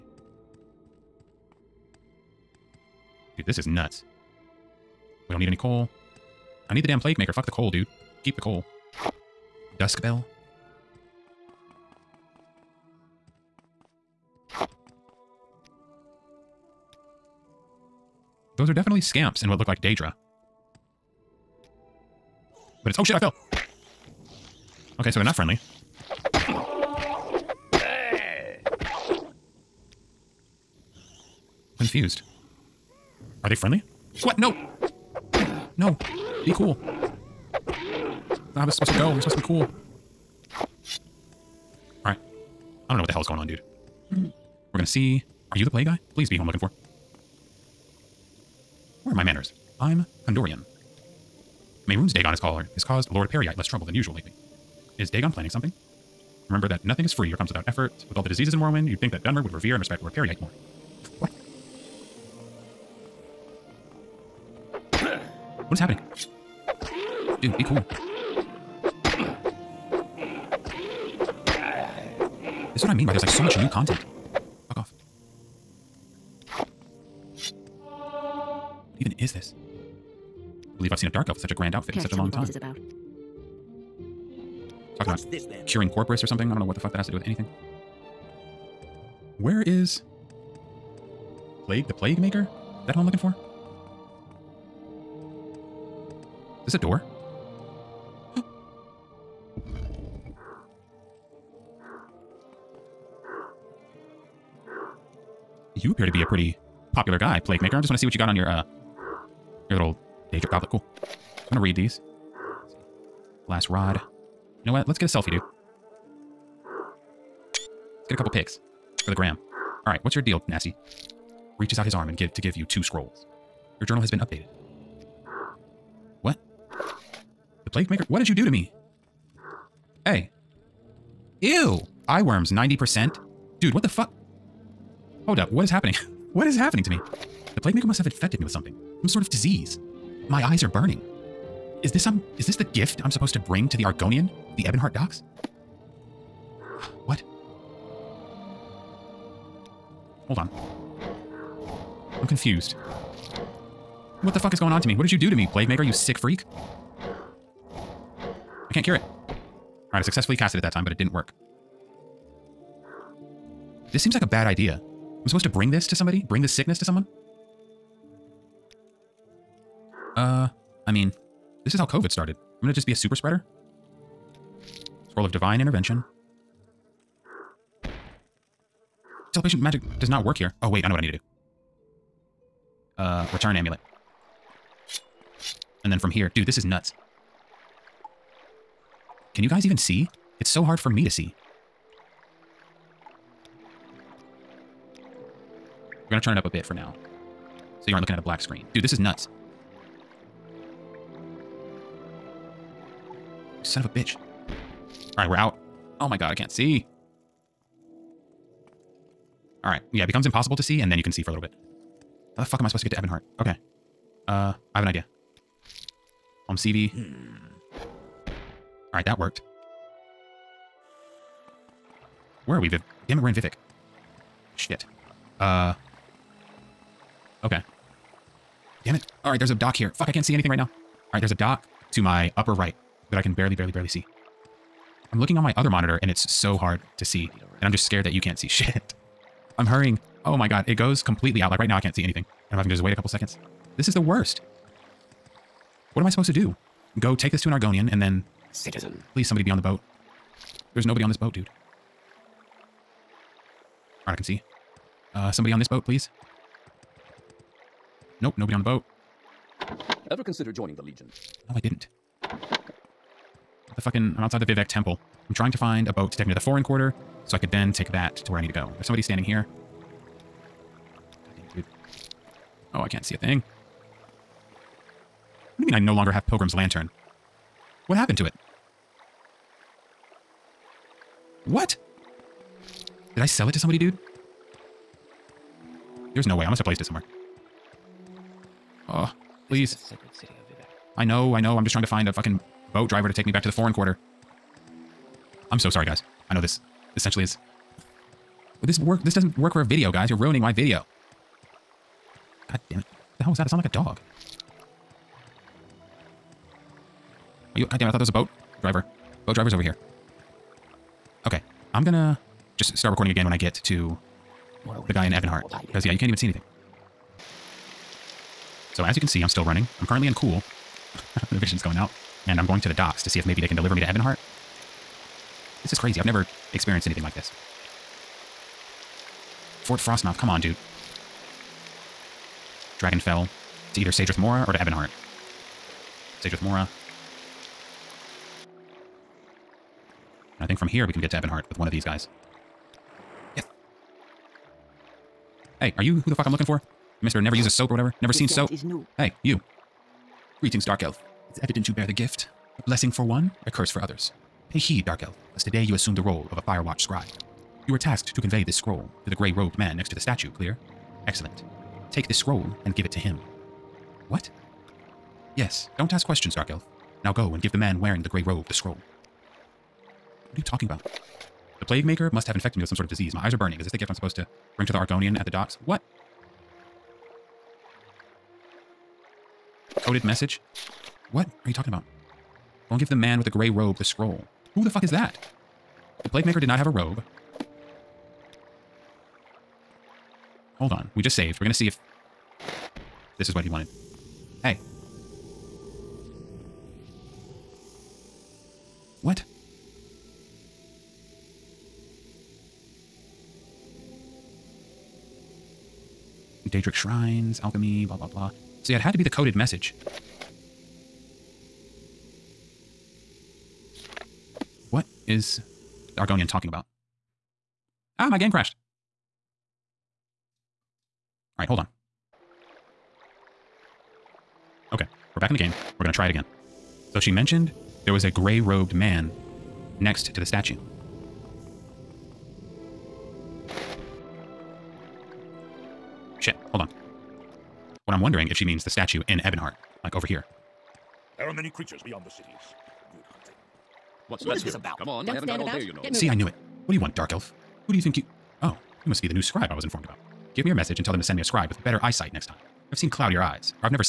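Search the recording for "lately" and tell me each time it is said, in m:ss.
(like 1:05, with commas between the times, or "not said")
0:54.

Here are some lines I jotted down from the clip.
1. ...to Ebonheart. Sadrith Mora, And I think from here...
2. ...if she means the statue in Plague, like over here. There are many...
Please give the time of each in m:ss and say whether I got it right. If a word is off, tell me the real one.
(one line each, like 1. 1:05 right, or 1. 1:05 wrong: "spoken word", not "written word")
1. 5:34 right
2. 7:18 wrong: "Ebonheart", not "Plague".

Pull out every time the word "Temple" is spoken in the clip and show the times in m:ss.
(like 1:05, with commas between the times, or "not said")
4:24.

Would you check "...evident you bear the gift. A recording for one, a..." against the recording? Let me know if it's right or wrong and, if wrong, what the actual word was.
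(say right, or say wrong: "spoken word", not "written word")
wrong: "blessing", not "recording".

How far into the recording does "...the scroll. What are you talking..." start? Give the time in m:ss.
6:08.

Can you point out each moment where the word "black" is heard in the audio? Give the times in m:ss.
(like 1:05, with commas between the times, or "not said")
3:18.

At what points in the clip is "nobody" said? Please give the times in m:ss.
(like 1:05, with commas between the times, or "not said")
4:10, 4:18.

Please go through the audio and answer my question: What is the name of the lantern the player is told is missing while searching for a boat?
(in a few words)
Pilgrim's Lantern.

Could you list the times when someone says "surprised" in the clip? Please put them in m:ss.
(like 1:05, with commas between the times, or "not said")
not said.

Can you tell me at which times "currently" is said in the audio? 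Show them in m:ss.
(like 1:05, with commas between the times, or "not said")
5:19.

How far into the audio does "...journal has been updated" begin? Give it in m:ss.
2:03.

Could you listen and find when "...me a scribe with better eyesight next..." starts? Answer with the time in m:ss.
7:31.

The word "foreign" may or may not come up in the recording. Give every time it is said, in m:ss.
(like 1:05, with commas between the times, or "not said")
4:26, 4:53.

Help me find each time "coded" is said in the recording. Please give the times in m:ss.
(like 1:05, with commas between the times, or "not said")
6:19, 6:49.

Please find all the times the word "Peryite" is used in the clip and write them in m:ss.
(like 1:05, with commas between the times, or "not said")
0:53, 1:00.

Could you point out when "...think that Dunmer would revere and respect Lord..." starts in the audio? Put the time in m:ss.
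0:59.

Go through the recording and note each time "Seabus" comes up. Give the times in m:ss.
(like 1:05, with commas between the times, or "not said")
not said.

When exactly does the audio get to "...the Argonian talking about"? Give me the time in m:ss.
6:55.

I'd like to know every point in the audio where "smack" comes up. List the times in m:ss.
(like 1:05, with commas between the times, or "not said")
not said.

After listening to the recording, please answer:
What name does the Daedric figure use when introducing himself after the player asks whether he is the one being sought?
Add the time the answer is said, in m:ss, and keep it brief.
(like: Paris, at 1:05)
Condorian, at 0:50.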